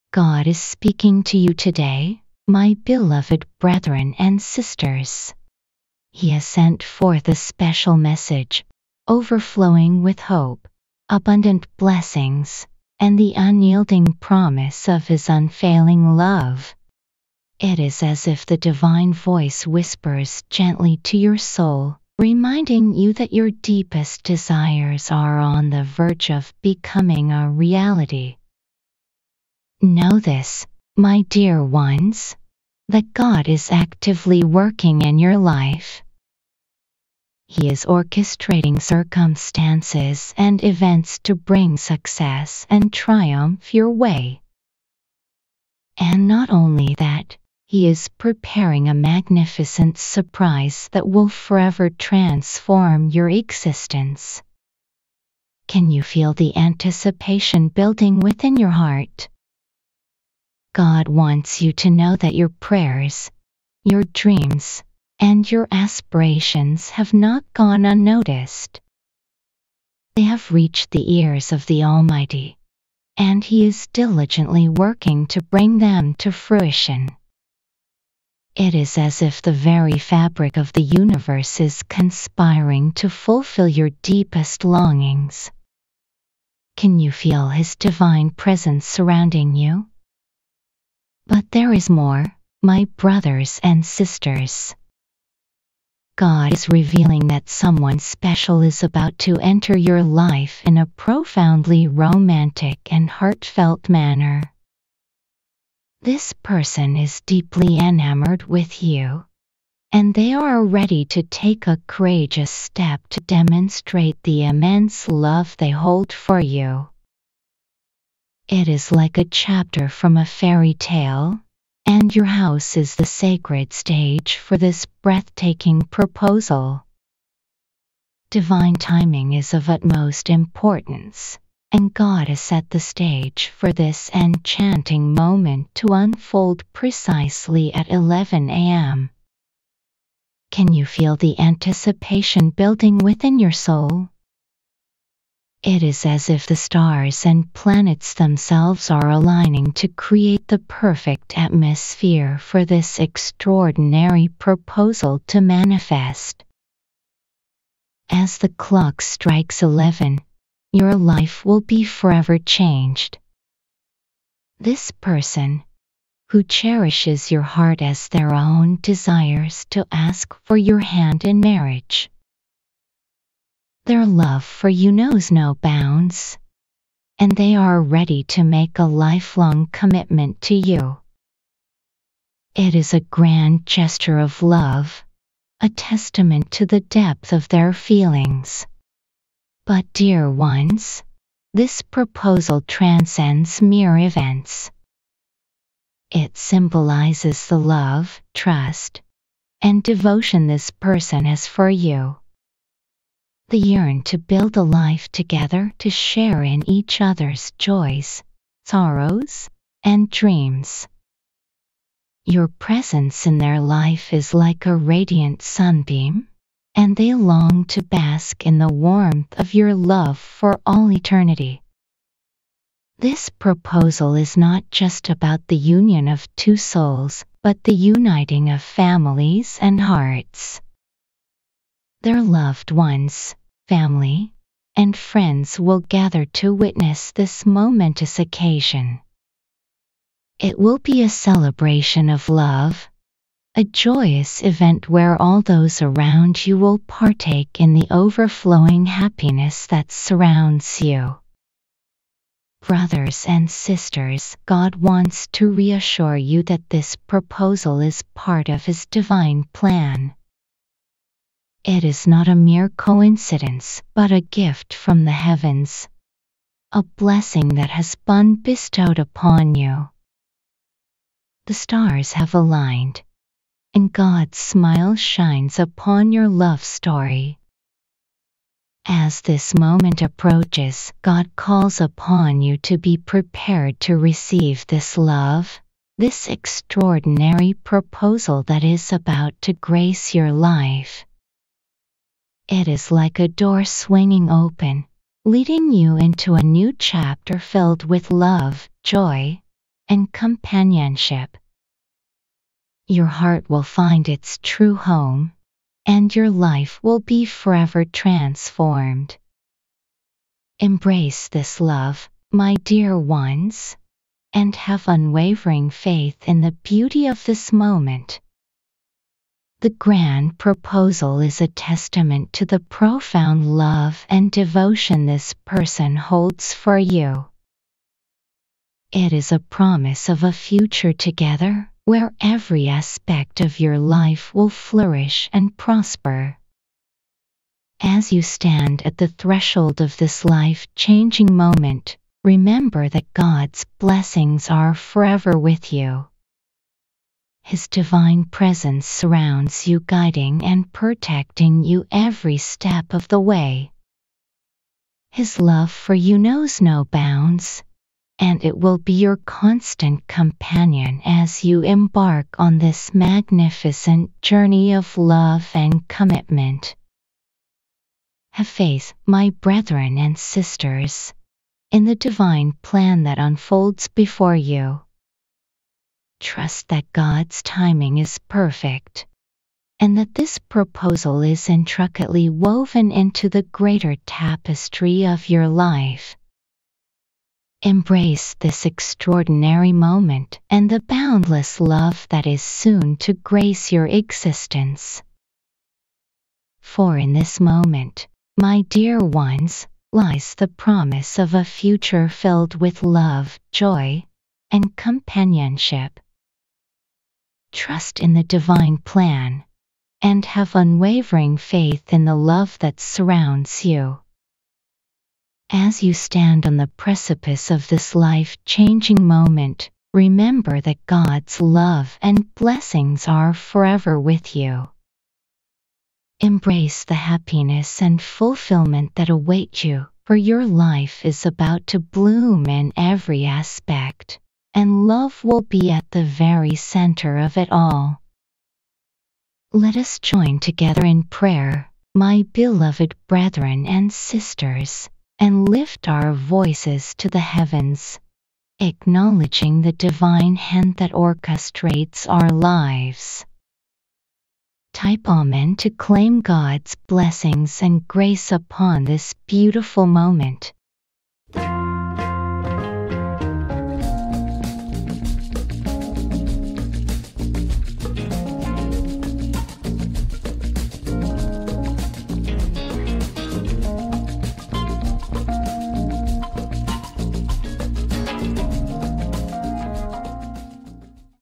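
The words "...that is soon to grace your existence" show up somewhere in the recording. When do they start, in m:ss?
6:32.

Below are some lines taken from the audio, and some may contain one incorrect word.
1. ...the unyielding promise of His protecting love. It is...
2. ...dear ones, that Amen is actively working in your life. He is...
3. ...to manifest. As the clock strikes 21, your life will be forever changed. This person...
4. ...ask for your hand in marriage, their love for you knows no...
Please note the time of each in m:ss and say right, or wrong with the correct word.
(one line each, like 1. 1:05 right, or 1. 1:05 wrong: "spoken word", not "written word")
1. 0:13 wrong: "unfailing", not "protecting"
2. 0:31 wrong: "God", not "Amen"
3. 2:35 wrong: "11", not "21"
4. 2:49 right.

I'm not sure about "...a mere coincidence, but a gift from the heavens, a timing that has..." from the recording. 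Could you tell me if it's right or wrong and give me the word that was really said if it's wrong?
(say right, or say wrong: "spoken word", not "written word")
wrong: "blessing", not "timing".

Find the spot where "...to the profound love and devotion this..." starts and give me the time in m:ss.
5:22.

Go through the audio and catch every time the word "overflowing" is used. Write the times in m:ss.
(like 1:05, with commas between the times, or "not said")
0:09, 4:07.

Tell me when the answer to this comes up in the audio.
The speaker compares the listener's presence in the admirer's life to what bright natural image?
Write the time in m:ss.
3:34.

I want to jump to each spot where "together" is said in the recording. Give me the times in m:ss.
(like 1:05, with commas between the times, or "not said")
3:25, 5:30, 7:20.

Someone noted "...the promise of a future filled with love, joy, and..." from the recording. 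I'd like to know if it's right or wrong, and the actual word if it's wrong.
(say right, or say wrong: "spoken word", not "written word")
right.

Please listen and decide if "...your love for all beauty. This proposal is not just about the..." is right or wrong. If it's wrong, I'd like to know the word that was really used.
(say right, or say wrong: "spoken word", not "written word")
wrong: "eternity", not "beauty".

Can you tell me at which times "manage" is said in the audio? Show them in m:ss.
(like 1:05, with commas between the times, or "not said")
not said.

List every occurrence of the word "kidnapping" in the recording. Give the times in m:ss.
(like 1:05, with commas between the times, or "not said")
not said.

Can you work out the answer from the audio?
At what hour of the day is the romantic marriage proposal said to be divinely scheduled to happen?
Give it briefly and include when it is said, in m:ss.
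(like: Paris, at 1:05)
11 a.m., at 2:17.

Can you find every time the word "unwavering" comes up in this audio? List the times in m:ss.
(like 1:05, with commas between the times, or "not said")
5:14, 6:50.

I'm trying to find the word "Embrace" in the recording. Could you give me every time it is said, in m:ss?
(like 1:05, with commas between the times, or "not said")
5:10, 6:27, 7:06.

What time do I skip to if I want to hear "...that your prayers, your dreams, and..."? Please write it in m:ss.
1:02.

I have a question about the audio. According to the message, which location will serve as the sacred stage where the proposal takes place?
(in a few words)
your house.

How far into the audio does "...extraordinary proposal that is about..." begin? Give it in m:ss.
4:46.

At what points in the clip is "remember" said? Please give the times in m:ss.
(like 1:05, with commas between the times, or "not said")
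5:42, 6:59.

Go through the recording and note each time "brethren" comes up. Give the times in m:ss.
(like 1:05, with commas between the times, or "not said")
0:03, 6:09, 7:23.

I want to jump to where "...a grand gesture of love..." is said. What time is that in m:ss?
3:02.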